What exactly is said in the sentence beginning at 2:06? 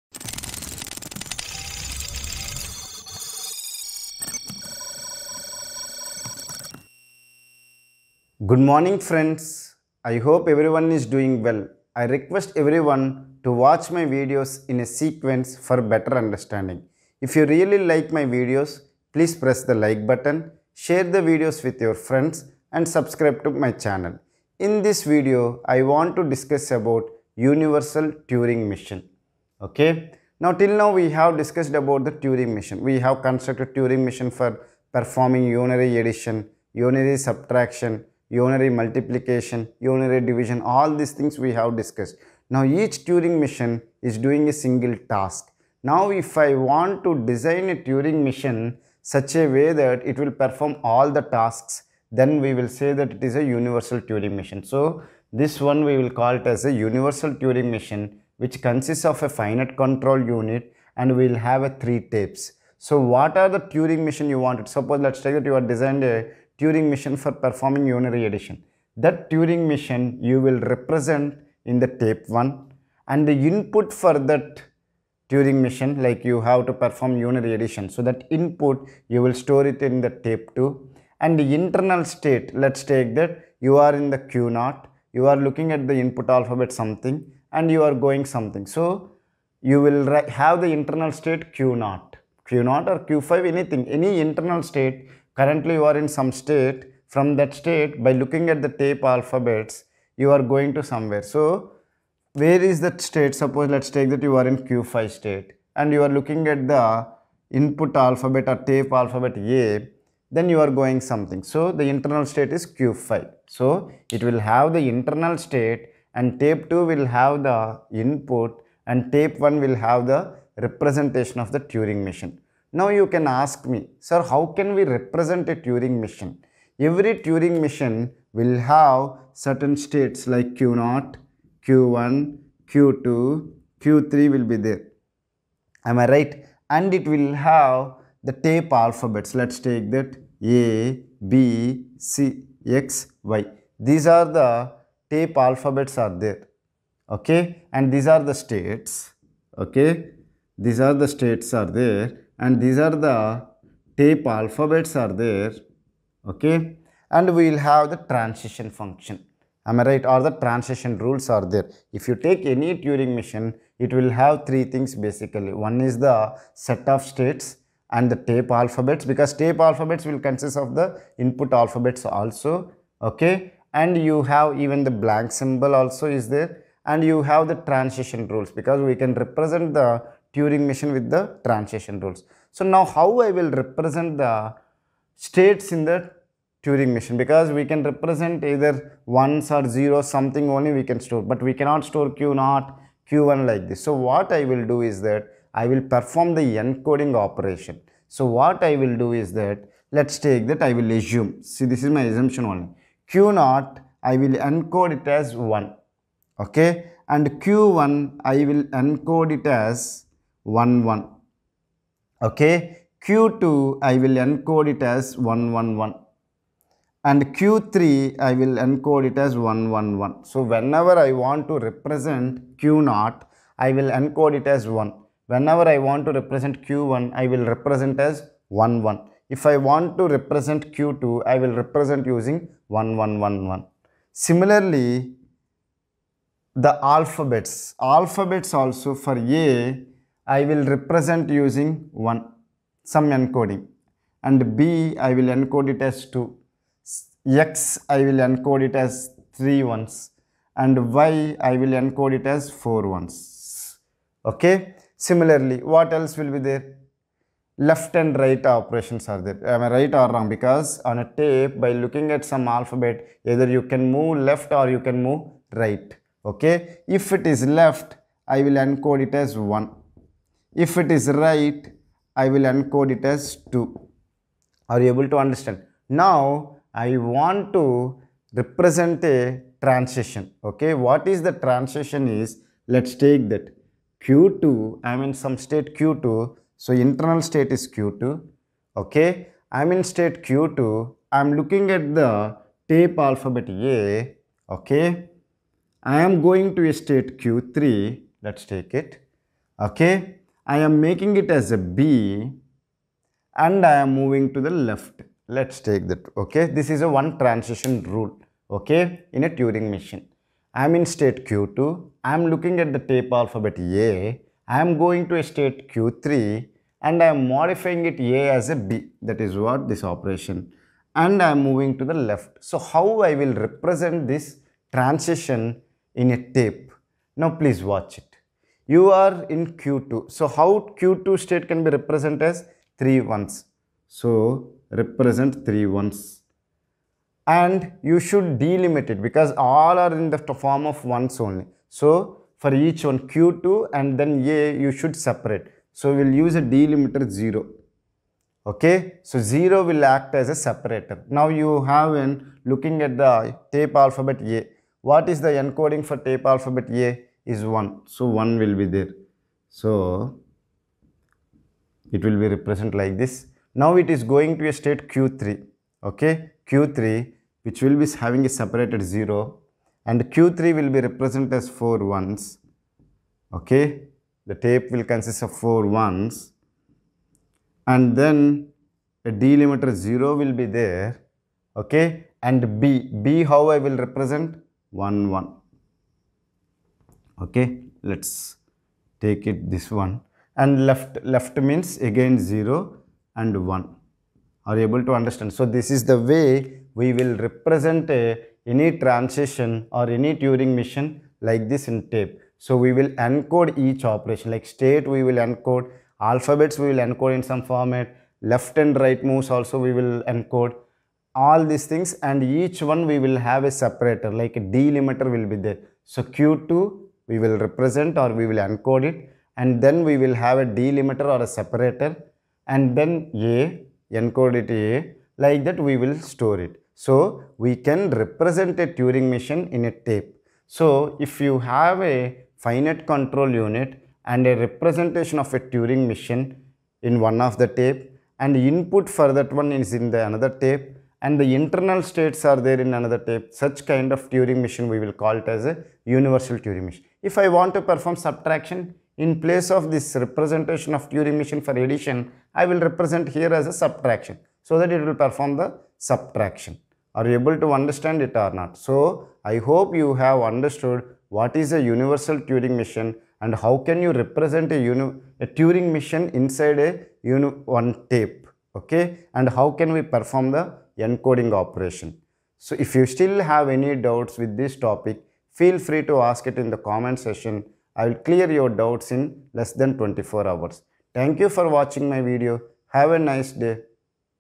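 Every Turing machine will have certain states like Q0, Q1, Q2, Q3 will be there.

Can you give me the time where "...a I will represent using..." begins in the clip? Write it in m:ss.
3:59.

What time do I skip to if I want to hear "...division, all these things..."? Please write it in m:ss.
0:40.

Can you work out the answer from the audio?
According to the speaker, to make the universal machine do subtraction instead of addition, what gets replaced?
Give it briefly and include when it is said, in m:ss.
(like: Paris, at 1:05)
representation of Turing machine, at 7:29.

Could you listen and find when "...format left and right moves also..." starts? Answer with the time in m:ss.
6:47.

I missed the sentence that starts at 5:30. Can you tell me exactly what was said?
So how Q2 state can be represented as three ones?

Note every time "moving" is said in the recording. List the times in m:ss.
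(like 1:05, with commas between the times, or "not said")
5:03, 5:21.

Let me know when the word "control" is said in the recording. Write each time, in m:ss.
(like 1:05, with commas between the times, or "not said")
0:59, 7:12.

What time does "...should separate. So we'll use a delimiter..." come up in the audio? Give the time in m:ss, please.
5:44.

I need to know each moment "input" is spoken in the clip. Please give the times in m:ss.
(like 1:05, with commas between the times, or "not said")
1:13, 1:18, 1:25, 1:47, 1:58, 2:51, 7:18.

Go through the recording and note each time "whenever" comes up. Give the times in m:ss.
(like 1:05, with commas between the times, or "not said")
3:40, 3:45.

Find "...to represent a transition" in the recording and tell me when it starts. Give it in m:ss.
4:37.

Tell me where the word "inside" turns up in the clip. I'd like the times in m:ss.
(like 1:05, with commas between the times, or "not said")
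7:46.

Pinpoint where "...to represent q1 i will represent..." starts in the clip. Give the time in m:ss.
3:46.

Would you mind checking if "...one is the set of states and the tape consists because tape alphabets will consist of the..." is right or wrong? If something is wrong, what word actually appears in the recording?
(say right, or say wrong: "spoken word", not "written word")
wrong: "alphabets", not "consists".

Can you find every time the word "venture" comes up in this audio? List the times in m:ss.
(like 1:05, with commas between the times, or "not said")
not said.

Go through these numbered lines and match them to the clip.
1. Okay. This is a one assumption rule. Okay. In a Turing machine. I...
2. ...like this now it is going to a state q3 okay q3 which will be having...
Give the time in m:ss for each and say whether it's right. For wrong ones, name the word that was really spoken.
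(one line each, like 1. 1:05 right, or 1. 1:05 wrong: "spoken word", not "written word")
1. 5:06 wrong: "transition", not "assumption"
2. 6:02 right.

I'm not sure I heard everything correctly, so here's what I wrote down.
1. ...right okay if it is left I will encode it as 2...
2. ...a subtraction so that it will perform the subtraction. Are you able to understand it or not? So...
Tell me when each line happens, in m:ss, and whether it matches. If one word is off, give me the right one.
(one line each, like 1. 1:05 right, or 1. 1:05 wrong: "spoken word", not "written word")
1. 4:25 wrong: "1", not "2"
2. 7:33 right.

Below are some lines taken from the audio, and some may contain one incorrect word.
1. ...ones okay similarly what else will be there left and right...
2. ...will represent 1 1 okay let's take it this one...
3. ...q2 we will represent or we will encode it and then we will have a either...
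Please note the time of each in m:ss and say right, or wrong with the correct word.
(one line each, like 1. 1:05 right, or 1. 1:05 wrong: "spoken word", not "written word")
1. 4:12 right
2. 6:23 right
3. 6:56 wrong: "delimiter", not "either".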